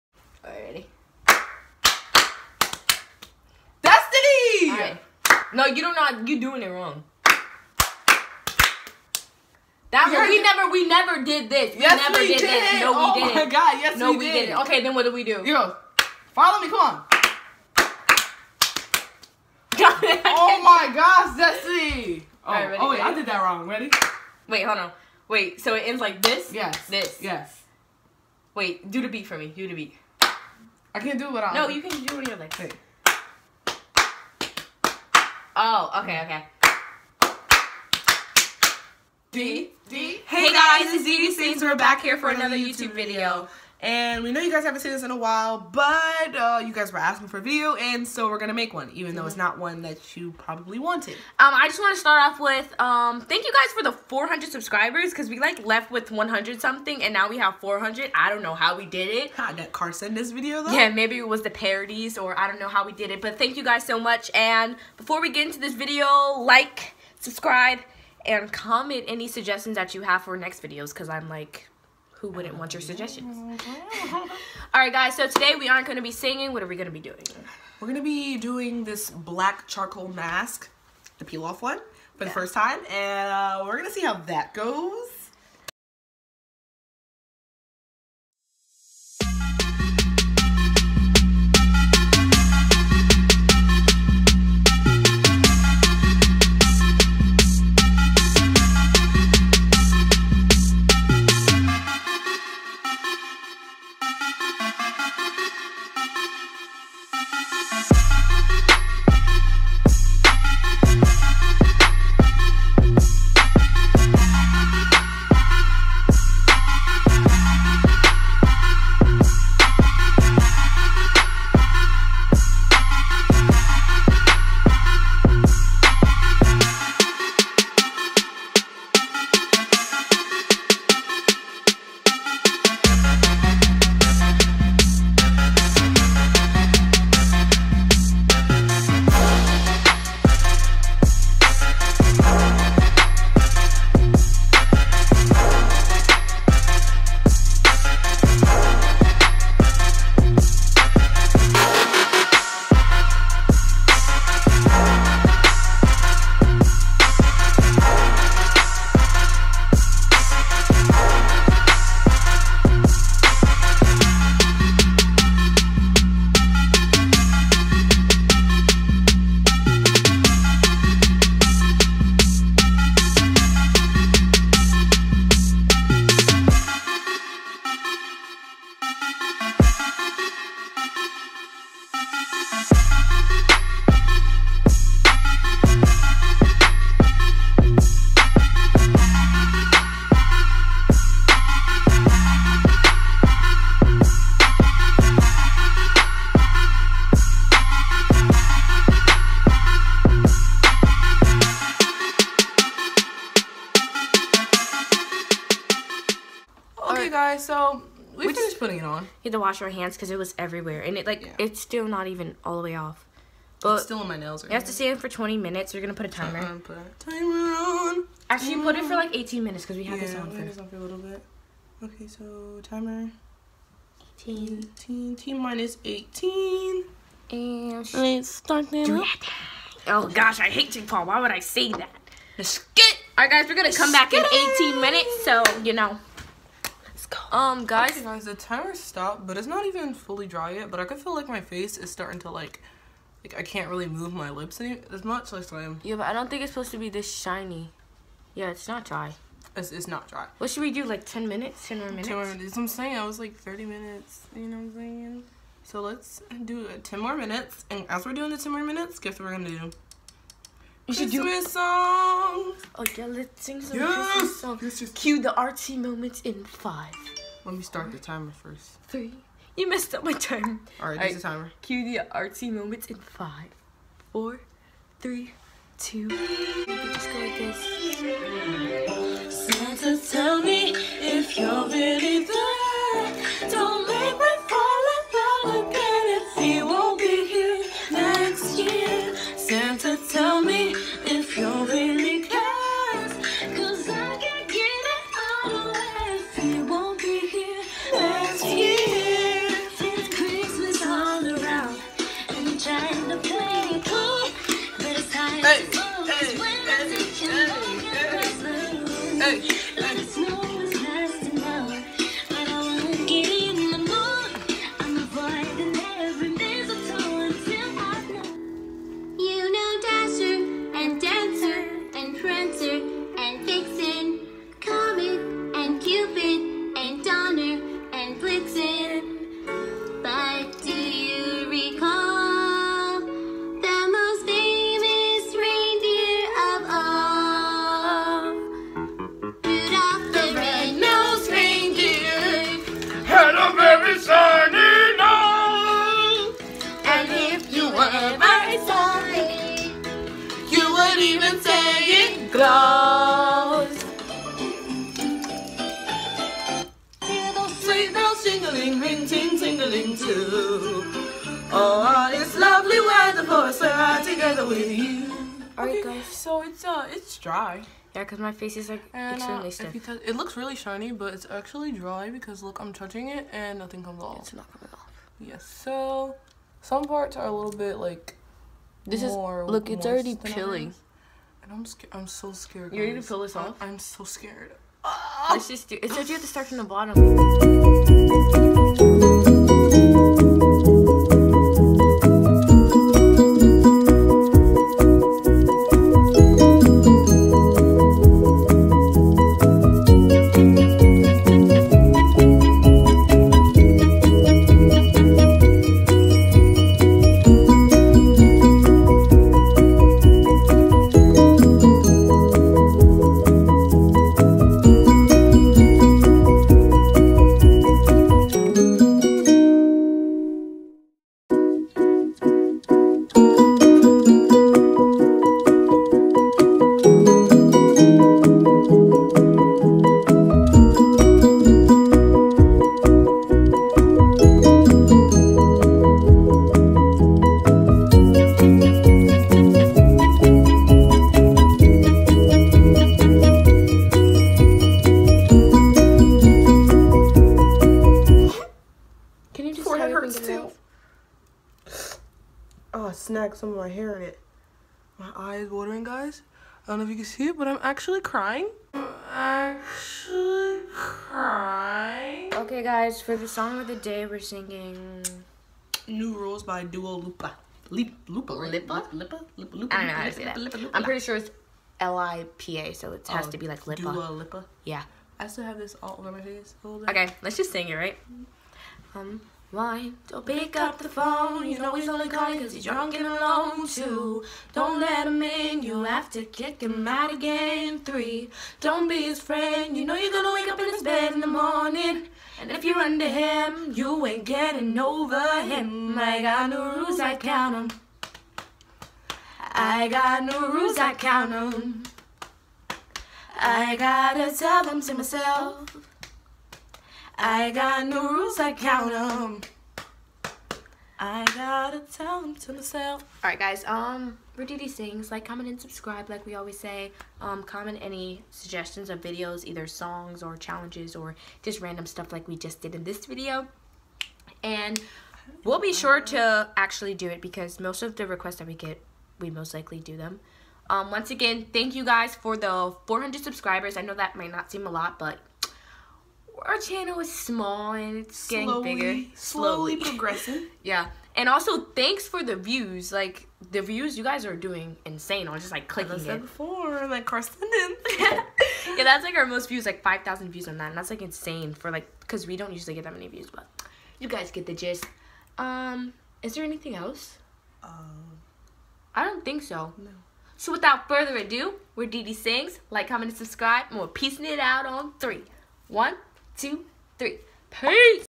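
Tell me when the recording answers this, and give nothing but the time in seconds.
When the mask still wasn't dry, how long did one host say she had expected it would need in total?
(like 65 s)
253 s.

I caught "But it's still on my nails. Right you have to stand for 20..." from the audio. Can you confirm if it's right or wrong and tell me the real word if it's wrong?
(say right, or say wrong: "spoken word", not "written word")
right.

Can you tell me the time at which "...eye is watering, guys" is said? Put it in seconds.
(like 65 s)
455 s.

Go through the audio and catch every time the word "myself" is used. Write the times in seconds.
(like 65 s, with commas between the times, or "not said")
504 s, 512 s.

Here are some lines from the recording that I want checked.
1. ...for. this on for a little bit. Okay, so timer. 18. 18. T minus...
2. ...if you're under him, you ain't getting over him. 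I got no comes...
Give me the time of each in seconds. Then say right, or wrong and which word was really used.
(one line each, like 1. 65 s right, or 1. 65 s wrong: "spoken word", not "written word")
1. 220 s right
2. 492 s wrong: "rules", not "comes".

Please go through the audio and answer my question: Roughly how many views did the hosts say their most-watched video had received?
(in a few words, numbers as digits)
5,000.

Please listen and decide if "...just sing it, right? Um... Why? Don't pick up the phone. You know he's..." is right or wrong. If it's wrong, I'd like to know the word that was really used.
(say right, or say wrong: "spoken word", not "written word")
right.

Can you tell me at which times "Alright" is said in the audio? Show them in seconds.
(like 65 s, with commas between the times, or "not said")
365 s, 513 s.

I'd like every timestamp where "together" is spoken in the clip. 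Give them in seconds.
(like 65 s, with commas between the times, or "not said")
364 s.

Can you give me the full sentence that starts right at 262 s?
Oh yeah, let's sing some yes.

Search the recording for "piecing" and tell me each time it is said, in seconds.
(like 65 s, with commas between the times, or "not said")
563 s.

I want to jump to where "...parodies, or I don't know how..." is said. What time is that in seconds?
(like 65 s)
61 s.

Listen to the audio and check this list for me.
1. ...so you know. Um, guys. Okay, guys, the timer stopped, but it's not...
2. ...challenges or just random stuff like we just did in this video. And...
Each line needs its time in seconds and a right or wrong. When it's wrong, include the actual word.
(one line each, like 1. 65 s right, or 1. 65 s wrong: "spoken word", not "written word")
1. 235 s right
2. 520 s right.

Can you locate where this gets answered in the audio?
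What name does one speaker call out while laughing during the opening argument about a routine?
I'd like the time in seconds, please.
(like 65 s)
21 s.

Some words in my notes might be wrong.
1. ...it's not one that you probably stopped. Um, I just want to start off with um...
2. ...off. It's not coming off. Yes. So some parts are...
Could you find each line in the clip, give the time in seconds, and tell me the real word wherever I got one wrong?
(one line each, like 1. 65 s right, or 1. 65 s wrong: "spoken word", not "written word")
1. 49 s wrong: "wanted", not "stopped"
2. 374 s right.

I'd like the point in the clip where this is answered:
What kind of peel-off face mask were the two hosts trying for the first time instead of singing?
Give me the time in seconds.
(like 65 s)
79 s.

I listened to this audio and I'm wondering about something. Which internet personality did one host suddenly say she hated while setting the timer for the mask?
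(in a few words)
Jake Paul.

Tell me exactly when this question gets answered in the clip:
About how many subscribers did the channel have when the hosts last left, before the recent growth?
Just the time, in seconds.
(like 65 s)
56 s.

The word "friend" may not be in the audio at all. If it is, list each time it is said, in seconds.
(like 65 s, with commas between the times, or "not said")
489 s.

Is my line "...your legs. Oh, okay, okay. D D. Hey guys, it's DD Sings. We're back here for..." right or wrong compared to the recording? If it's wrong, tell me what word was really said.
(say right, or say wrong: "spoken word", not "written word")
right.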